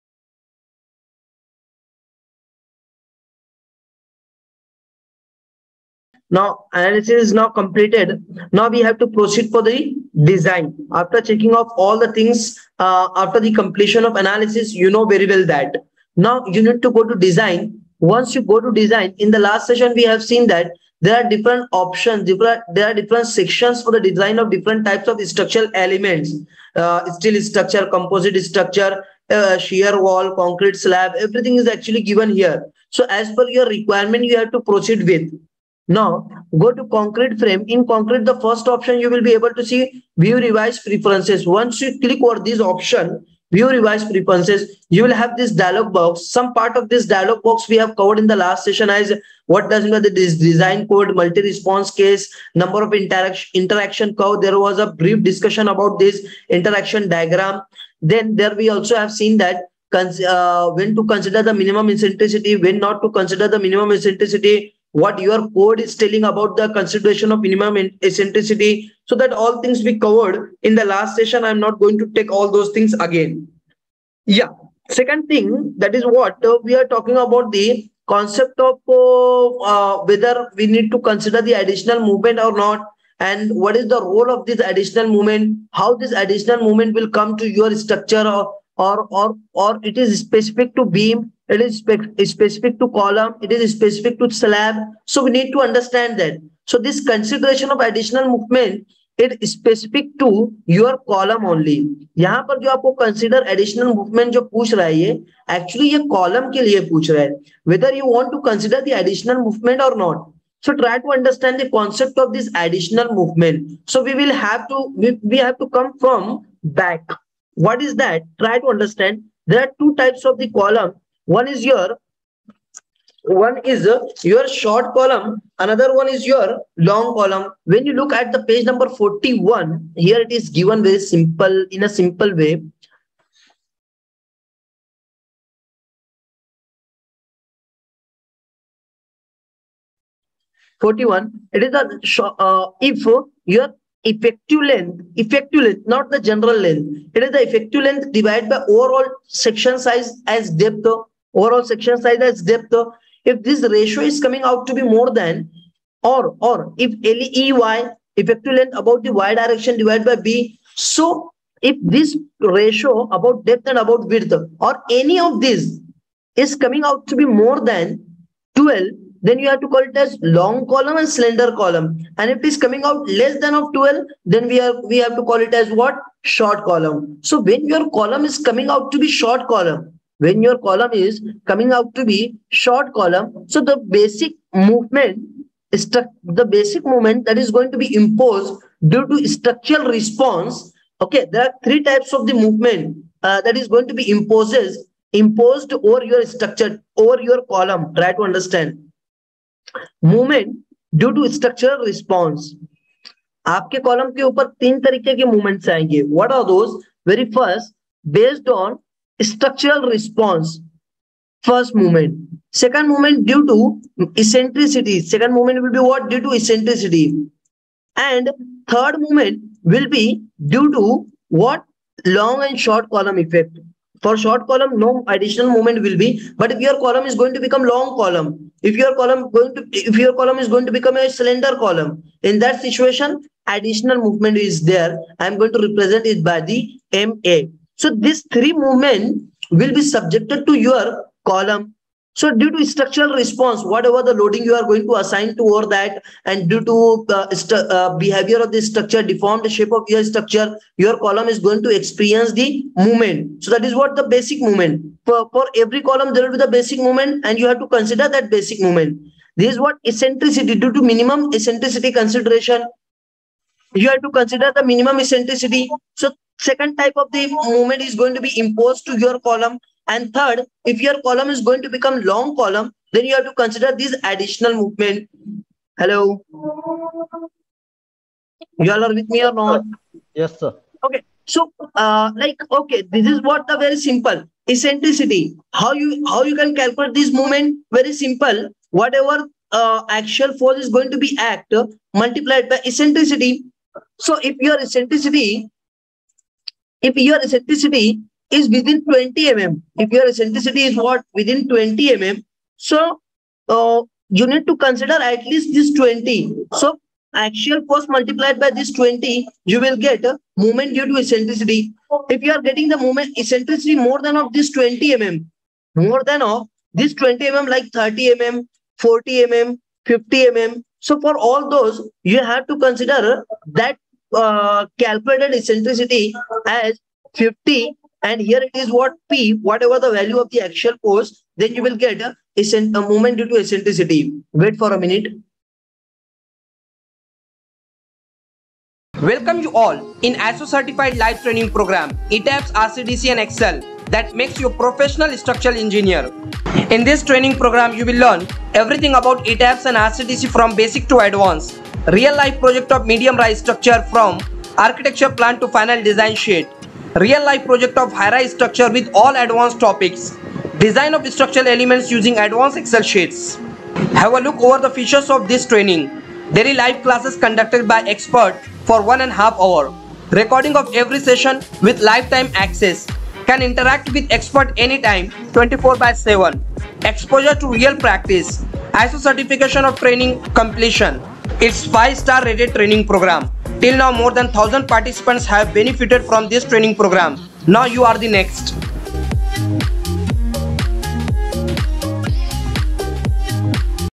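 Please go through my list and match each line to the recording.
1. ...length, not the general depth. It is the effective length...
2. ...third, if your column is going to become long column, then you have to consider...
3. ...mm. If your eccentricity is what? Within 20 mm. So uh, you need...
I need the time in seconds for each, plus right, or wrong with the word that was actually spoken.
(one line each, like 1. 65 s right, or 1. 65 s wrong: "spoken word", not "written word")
1. 145 s wrong: "length", not "depth"
2. 270 s right
3. 299 s right.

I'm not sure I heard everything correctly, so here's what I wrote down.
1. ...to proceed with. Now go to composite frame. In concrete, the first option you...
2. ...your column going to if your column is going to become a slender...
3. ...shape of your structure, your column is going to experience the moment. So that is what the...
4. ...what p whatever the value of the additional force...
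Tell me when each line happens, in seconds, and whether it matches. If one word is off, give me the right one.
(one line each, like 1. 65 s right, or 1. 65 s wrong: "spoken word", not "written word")
1. 34 s wrong: "concrete", not "composite"
2. 228 s right
3. 249 s wrong: "movement", not "moment"
4. 328 s wrong: "actual", not "additional".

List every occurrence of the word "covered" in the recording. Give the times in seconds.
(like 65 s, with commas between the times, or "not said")
47 s, 69 s.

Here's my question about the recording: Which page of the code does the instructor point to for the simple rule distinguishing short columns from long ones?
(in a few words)
41.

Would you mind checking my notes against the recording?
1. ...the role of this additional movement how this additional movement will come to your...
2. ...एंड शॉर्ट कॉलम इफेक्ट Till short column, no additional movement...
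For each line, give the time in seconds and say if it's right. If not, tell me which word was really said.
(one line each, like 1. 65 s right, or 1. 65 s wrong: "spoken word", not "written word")
1. 83 s right
2. 222 s wrong: "For", not "Till".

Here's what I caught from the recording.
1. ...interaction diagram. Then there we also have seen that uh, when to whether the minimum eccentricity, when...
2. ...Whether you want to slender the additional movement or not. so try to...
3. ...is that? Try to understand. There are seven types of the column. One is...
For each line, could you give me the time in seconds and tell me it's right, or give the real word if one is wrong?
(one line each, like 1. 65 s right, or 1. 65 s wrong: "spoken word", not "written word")
1. 56 s wrong: "consider", not "whether"
2. 107 s wrong: "consider", not "slender"
3. 117 s wrong: "two", not "seven".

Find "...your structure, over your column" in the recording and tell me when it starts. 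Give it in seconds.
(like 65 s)
196 s.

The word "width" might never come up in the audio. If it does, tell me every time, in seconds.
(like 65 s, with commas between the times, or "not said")
164 s.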